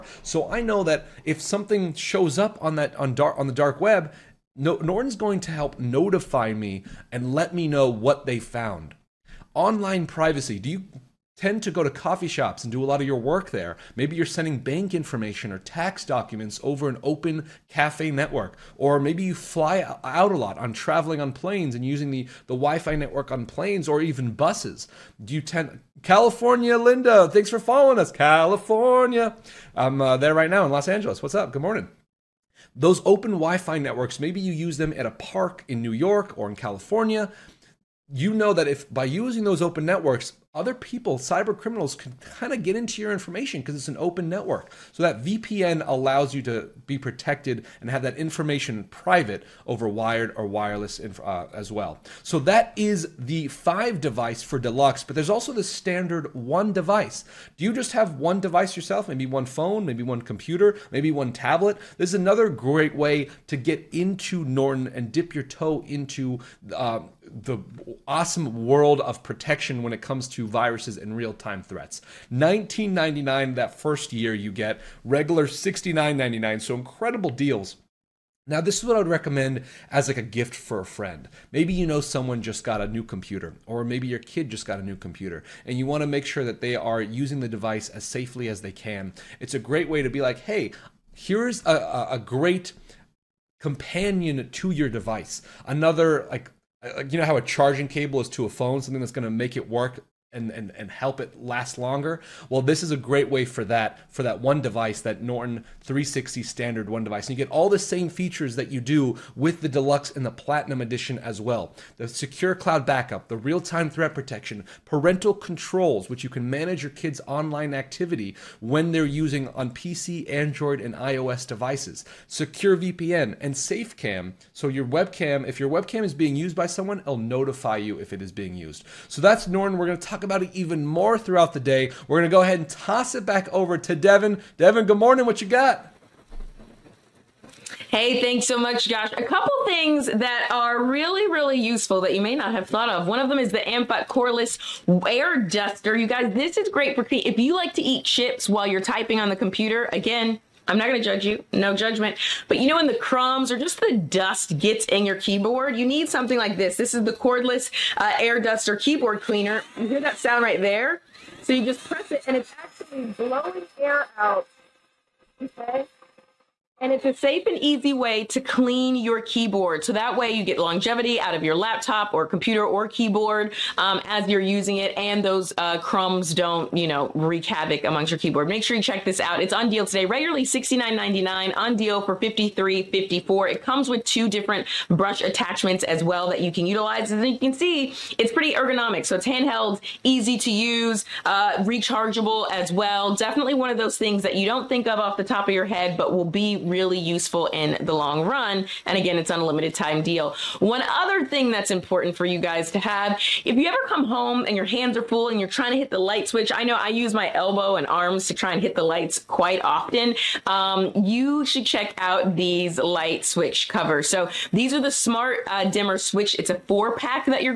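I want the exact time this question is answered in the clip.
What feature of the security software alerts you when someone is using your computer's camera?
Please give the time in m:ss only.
2:03.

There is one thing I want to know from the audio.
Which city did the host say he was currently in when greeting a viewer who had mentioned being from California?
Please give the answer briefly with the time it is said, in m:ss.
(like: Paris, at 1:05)
Los Angeles, at 0:30.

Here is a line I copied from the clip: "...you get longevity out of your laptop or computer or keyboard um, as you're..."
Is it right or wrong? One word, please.
right.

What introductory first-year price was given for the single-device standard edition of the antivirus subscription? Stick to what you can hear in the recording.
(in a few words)
$19.99.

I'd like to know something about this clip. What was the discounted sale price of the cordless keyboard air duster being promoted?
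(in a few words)
$53.54.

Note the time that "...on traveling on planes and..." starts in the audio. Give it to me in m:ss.
0:20.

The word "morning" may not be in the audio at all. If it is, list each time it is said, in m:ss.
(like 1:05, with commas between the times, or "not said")
0:31, 2:14.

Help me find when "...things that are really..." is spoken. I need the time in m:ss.
2:19.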